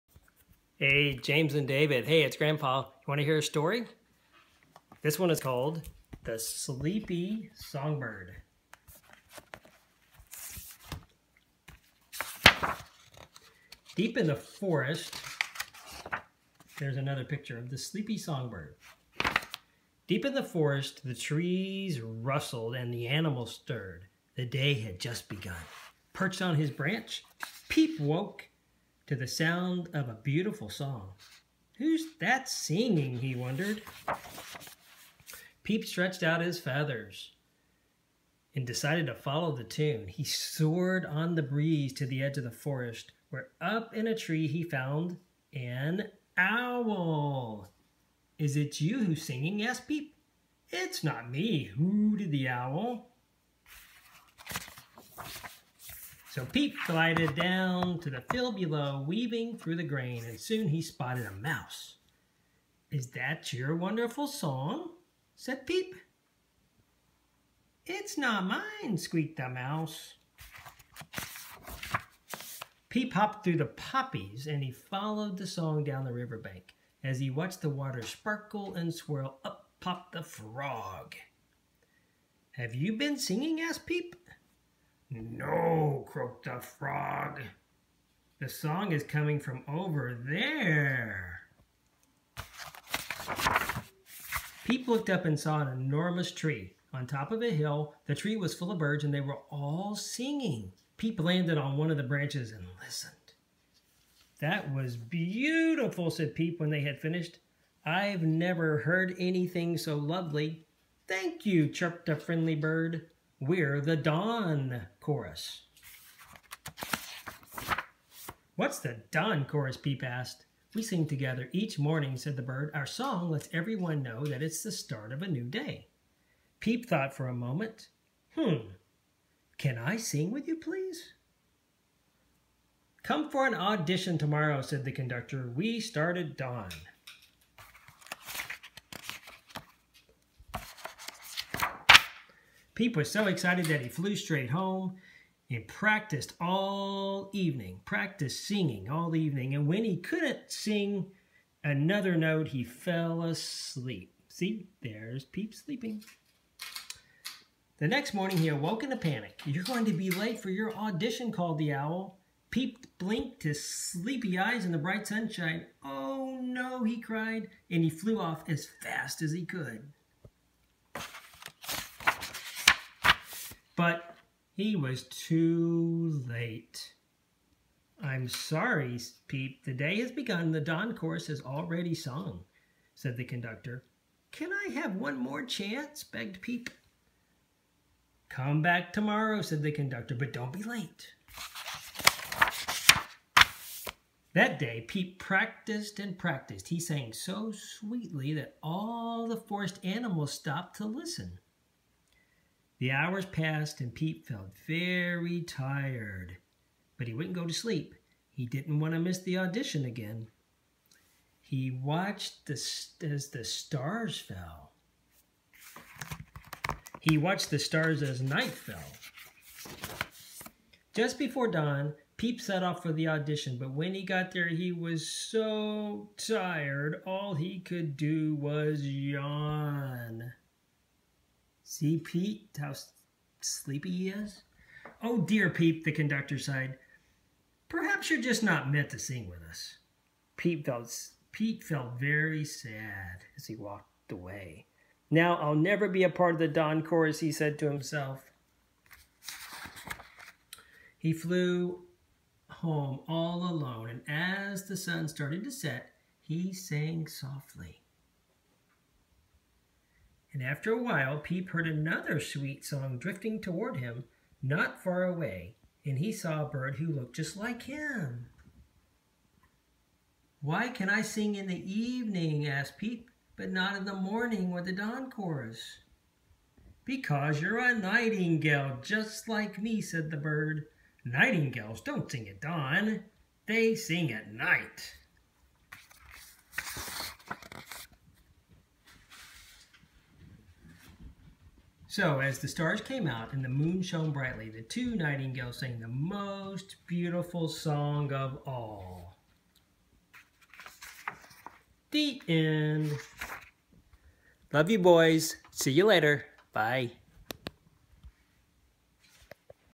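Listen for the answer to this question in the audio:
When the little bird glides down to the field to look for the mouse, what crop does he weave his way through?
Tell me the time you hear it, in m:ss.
0:59.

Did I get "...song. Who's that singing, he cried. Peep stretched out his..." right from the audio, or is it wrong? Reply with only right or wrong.
wrong.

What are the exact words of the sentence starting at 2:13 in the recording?
Come for an audition tomorrow, said the conductor.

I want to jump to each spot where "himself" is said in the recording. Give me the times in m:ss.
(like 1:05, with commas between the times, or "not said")
4:07.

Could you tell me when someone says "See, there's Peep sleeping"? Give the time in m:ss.
2:34.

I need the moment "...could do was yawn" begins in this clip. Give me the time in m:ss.
3:47.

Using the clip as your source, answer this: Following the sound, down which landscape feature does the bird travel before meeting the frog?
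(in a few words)
riverbank.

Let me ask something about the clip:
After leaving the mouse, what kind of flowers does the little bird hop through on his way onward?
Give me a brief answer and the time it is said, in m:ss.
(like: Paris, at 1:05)
poppies, at 1:13.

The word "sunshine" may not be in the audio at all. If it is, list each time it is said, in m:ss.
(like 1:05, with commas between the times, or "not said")
2:45.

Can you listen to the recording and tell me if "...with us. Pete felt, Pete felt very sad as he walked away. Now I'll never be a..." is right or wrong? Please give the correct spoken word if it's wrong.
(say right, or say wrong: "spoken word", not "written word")
right.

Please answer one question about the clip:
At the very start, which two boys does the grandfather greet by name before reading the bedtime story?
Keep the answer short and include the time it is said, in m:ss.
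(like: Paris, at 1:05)
James and David, at 0:01.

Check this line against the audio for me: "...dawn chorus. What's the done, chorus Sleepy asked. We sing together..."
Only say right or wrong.
wrong.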